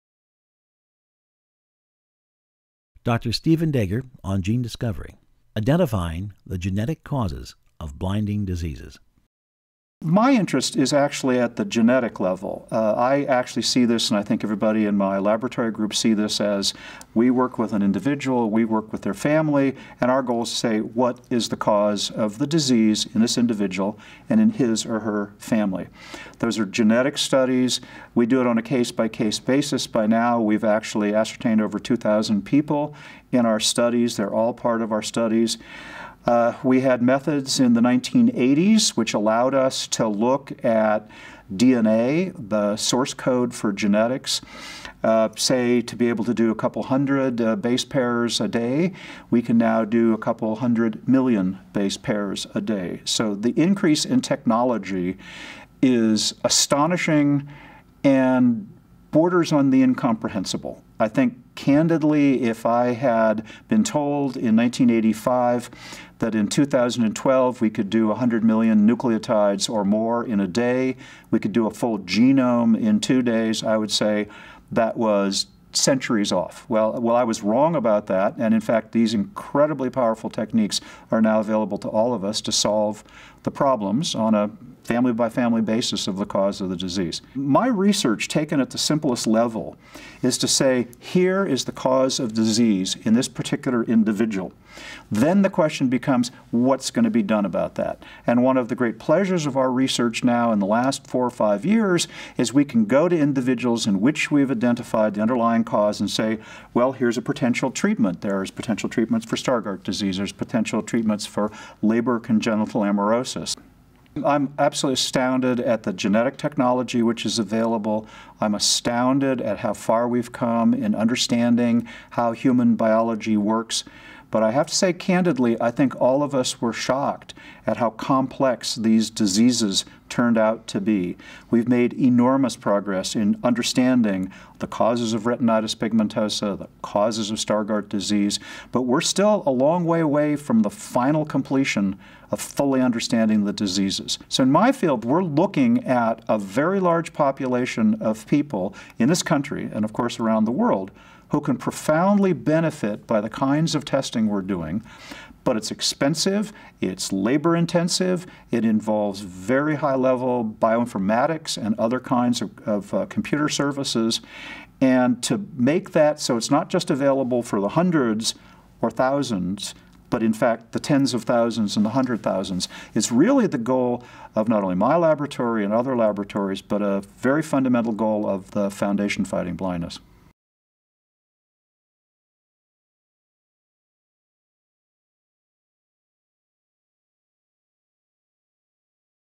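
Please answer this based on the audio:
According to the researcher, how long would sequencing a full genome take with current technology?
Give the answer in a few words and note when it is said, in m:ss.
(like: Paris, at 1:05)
2 days, at 1:12.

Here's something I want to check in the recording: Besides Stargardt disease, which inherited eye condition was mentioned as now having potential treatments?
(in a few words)
Leber congenital amaurosis.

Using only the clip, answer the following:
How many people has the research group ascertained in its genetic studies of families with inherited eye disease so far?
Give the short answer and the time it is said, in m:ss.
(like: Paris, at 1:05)
over 2,000, at 0:31.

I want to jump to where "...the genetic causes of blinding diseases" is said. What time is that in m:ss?
0:06.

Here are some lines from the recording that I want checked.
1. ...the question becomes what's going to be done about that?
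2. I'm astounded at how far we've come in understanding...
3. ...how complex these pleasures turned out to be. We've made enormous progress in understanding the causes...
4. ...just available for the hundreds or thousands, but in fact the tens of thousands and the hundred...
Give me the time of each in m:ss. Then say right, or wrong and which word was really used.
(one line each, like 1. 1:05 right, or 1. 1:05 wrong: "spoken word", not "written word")
1. 1:35 right
2. 1:58 right
3. 2:07 wrong: "diseases", not "pleasures"
4. 2:46 right.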